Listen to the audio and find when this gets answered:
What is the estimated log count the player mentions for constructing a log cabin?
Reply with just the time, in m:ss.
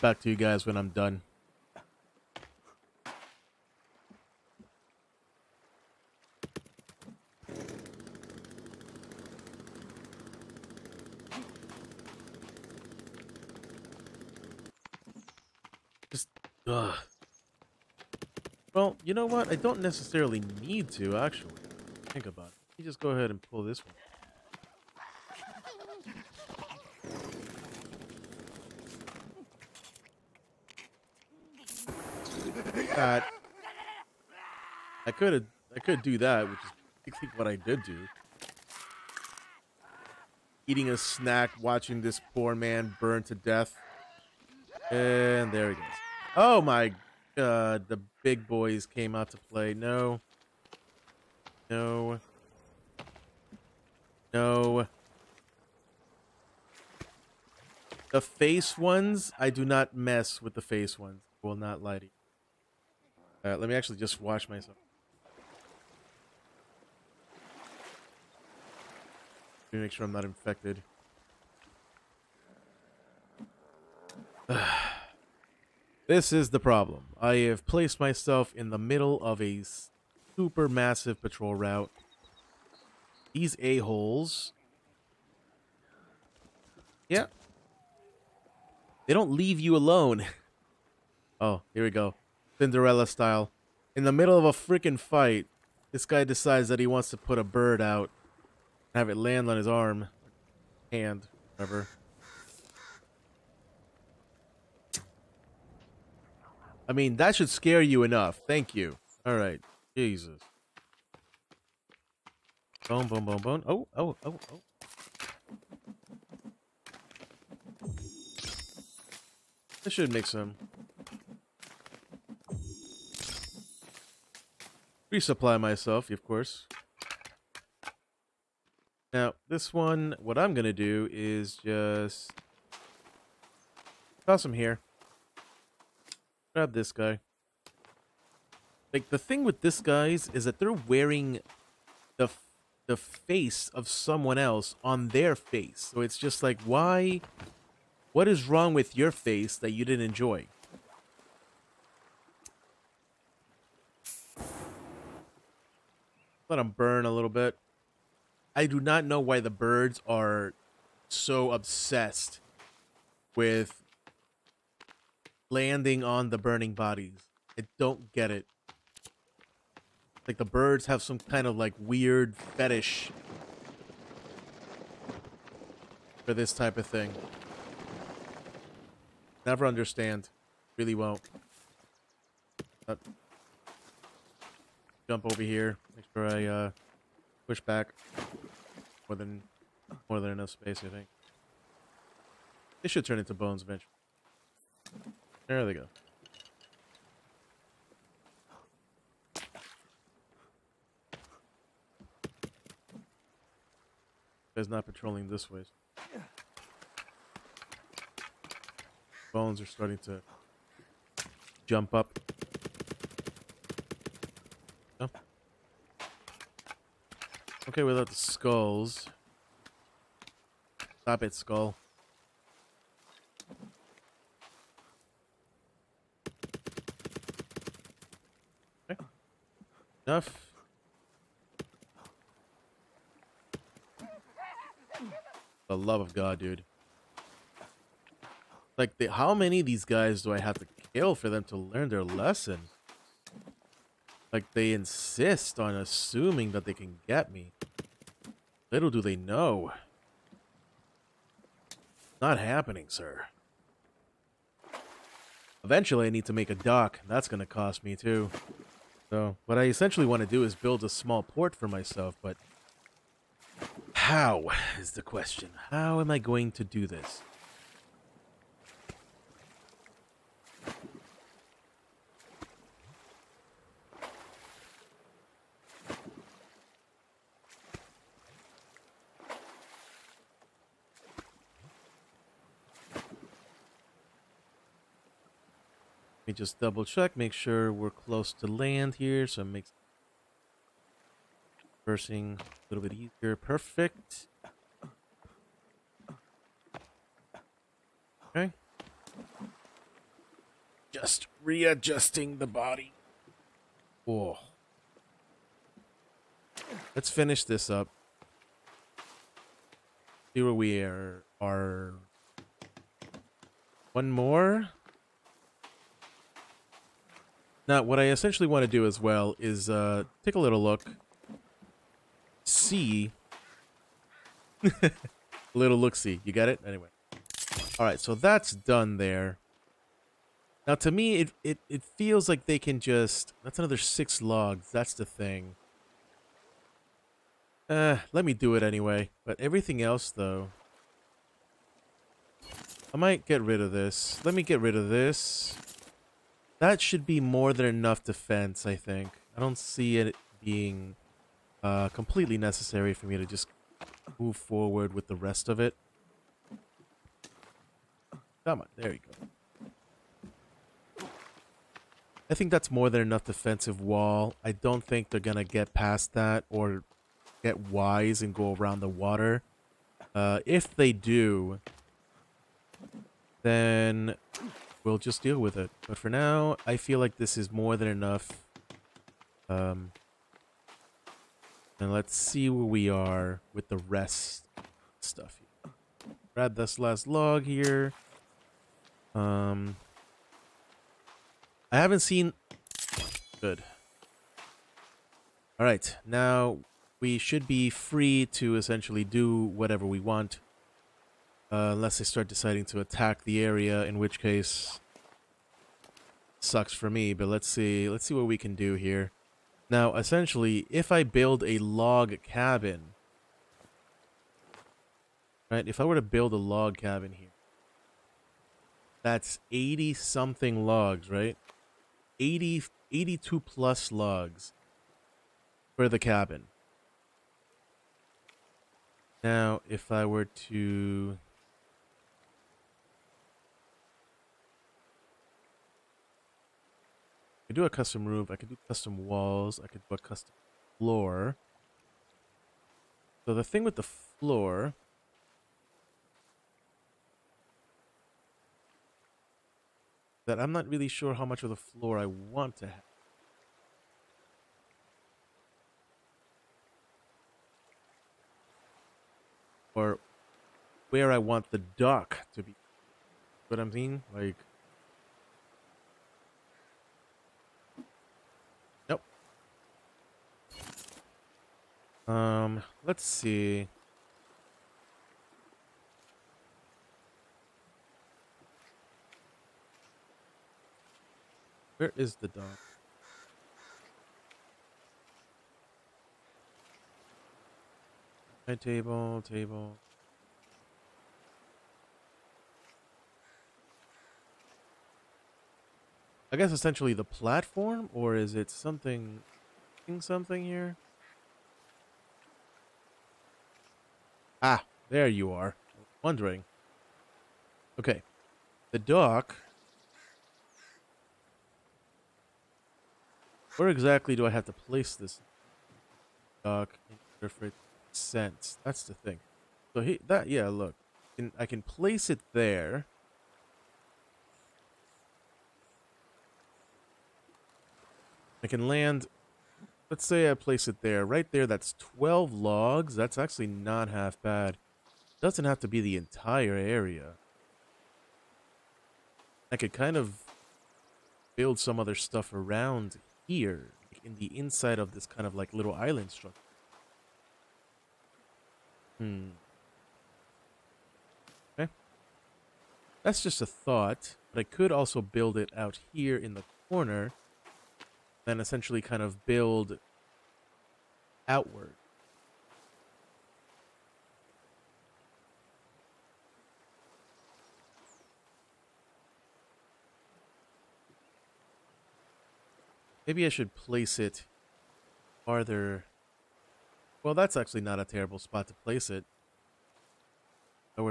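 7:02.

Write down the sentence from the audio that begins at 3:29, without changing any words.
Bones are starting to jump up.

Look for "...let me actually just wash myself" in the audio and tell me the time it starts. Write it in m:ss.
1:03.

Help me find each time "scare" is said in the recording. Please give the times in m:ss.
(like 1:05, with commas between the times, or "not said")
1:47.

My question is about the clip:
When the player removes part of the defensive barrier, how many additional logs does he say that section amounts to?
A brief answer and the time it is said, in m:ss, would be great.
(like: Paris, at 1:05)
6 logs, at 5:33.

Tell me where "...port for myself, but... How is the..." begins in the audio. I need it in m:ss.
4:21.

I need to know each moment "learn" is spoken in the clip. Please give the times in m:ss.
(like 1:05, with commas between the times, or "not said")
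4:01.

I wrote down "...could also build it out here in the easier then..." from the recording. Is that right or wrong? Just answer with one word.
wrong.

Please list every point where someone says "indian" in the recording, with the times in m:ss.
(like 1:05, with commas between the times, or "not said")
not said.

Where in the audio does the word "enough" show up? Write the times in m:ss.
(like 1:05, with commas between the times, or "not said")
1:48, 3:10, 3:50, 5:47, 6:03, 6:17.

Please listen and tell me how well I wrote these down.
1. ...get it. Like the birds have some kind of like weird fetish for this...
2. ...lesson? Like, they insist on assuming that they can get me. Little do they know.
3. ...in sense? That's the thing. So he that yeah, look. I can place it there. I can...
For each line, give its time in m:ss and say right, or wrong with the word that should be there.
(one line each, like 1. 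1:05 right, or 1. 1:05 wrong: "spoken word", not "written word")
1. 2:48 right
2. 4:02 right
3. 8:37 right.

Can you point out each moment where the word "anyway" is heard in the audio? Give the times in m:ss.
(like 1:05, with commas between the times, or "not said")
5:26, 5:38.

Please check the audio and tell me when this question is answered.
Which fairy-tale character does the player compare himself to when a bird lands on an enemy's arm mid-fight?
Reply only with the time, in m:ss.
1:32.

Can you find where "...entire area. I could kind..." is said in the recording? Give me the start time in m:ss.
8:55.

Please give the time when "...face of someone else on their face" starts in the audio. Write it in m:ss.
2:22.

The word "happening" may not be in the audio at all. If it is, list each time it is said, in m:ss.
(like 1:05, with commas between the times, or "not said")
4:12.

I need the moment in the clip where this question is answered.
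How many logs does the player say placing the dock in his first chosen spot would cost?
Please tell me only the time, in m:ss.
8:51.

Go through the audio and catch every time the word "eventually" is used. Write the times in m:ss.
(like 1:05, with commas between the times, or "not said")
3:13, 4:15.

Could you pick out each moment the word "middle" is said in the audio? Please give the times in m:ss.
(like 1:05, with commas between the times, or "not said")
1:18, 1:34.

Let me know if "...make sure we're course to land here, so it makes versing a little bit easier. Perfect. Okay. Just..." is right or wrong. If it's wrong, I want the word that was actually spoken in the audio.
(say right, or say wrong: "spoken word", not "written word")
wrong: "close", not "course".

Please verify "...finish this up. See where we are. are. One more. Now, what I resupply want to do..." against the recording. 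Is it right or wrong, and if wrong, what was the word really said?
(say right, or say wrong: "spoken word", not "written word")
wrong: "essentially", not "resupply".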